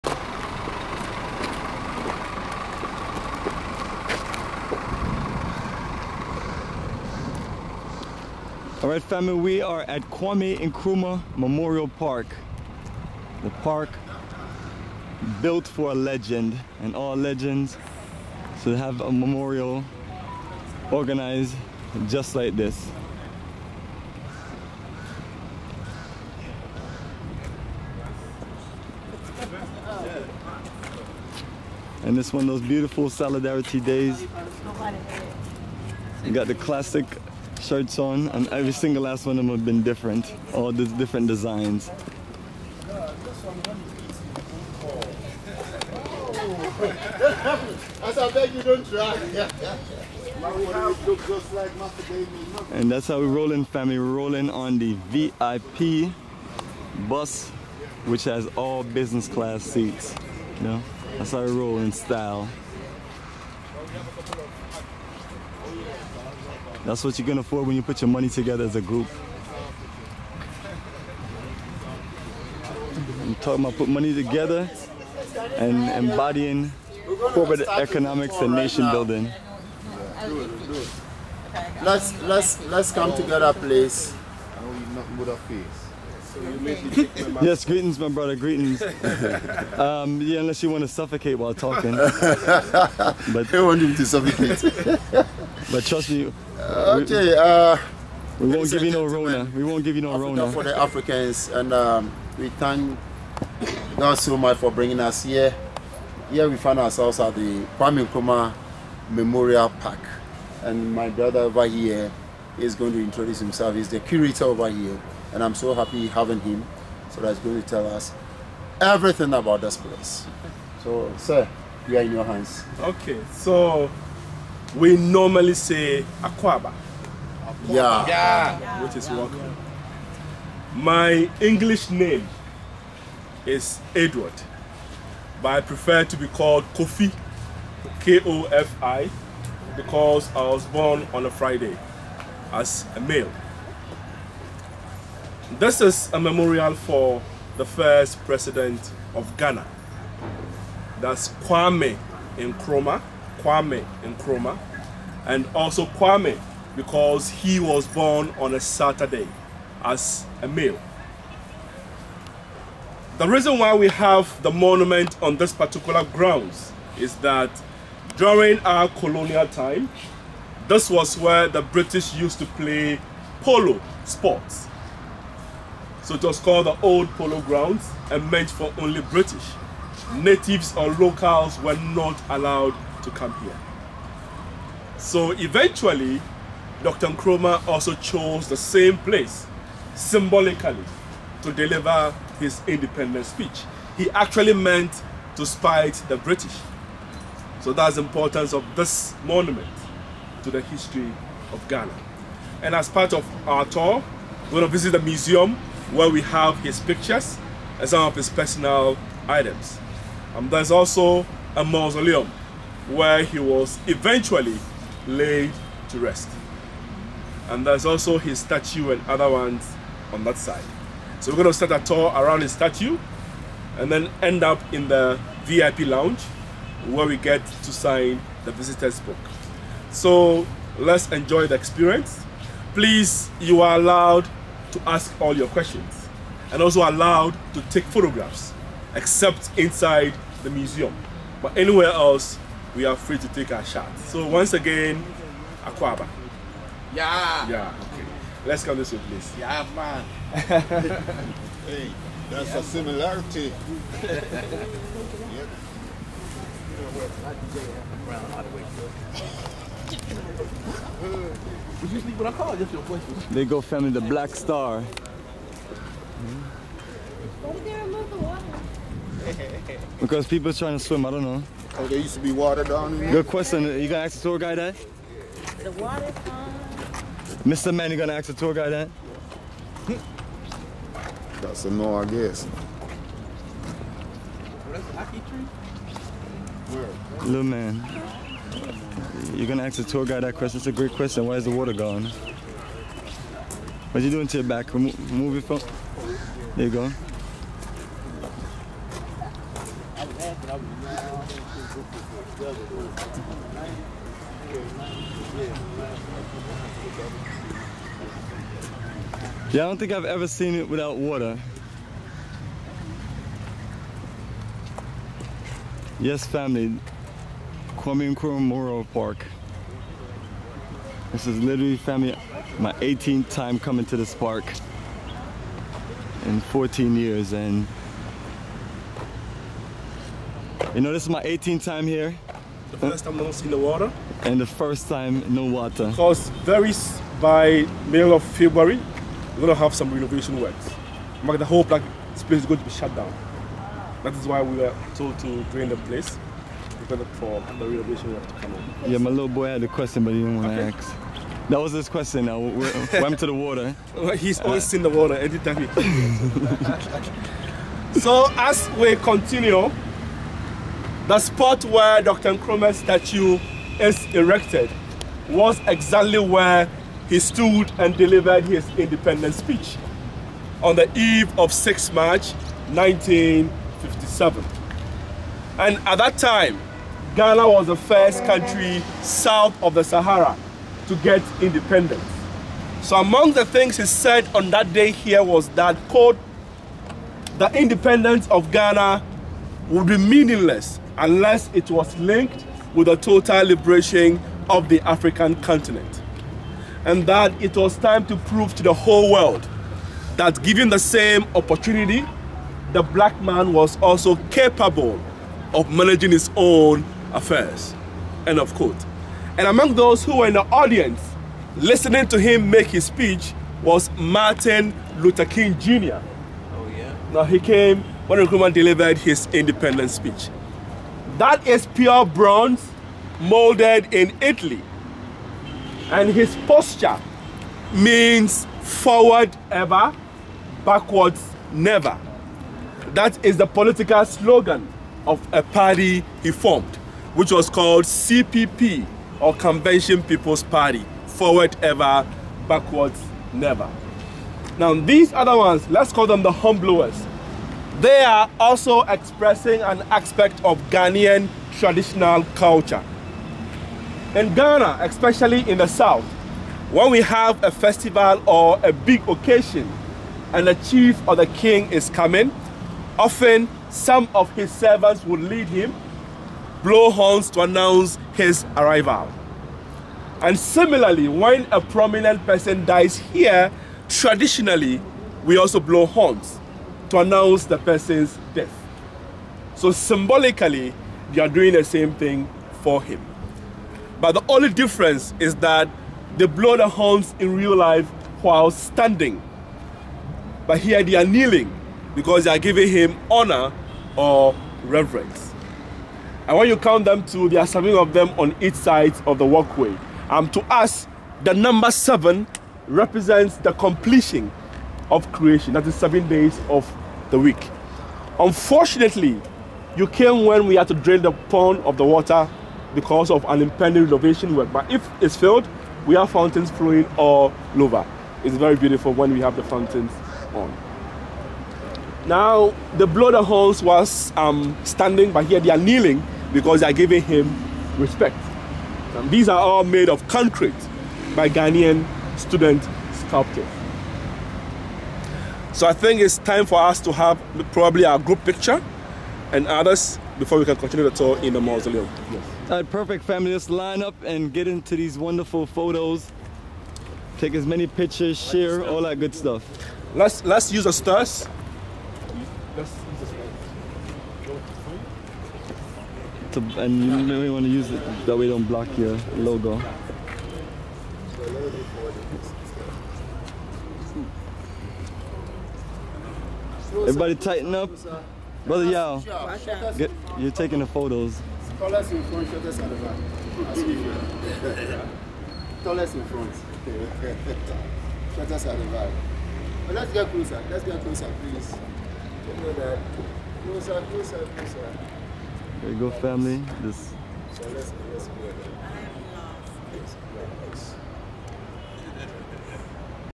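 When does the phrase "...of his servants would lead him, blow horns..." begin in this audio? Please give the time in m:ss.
7:44.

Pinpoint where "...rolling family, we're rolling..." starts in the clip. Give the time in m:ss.
0:53.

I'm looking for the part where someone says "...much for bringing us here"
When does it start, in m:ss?
1:44.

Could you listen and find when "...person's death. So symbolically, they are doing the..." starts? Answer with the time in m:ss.
7:57.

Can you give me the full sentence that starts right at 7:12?
That is the political slogan of a party he formed, which was called CPP or Convention People's Party, forward ever, backwards never.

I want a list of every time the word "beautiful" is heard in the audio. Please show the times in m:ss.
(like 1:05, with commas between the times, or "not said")
0:32, 8:38.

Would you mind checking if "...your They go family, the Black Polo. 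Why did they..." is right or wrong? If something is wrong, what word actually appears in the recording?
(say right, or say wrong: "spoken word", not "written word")
wrong: "Star", not "Polo".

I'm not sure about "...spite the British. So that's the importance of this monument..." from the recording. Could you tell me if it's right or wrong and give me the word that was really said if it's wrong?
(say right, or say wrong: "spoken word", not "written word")
right.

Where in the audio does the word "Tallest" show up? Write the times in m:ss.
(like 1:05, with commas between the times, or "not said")
9:31, 9:35.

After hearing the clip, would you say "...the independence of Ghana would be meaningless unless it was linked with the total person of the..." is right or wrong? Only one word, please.
wrong.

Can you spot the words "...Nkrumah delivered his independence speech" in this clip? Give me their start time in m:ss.
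6:58.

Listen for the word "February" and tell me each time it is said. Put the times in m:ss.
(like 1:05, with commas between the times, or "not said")
5:38.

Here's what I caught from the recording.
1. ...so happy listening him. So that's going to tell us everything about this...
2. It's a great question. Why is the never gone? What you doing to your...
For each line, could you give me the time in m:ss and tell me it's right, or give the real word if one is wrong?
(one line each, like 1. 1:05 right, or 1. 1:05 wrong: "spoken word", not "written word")
1. 1:55 wrong: "having", not "listening"
2. 4:50 wrong: "water", not "never".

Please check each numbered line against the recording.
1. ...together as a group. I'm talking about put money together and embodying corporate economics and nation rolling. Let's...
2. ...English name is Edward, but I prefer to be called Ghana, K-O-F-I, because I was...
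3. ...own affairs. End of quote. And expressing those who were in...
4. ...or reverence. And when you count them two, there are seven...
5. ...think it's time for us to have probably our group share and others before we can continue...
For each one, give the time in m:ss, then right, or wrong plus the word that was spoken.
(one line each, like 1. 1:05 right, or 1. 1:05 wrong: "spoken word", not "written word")
1. 1:08 wrong: "building", not "rolling"
2. 2:11 wrong: "Kofi", not "Ghana"
3. 6:46 wrong: "among", not "expressing"
4. 8:13 right
5. 8:55 wrong: "picture", not "share".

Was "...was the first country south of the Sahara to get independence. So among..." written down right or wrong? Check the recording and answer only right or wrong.
right.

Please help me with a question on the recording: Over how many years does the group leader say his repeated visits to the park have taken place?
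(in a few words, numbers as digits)
14.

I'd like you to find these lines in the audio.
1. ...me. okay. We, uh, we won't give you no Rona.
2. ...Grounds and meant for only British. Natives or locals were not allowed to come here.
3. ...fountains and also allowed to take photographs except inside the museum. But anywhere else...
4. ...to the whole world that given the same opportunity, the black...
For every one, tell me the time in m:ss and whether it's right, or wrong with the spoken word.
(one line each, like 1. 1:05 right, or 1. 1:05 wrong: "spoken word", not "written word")
1. 1:36 right
2. 2:57 right
3. 3:55 wrong: "questions", not "fountains"
4. 6:38 right.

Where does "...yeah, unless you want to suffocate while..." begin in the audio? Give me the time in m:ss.
1:30.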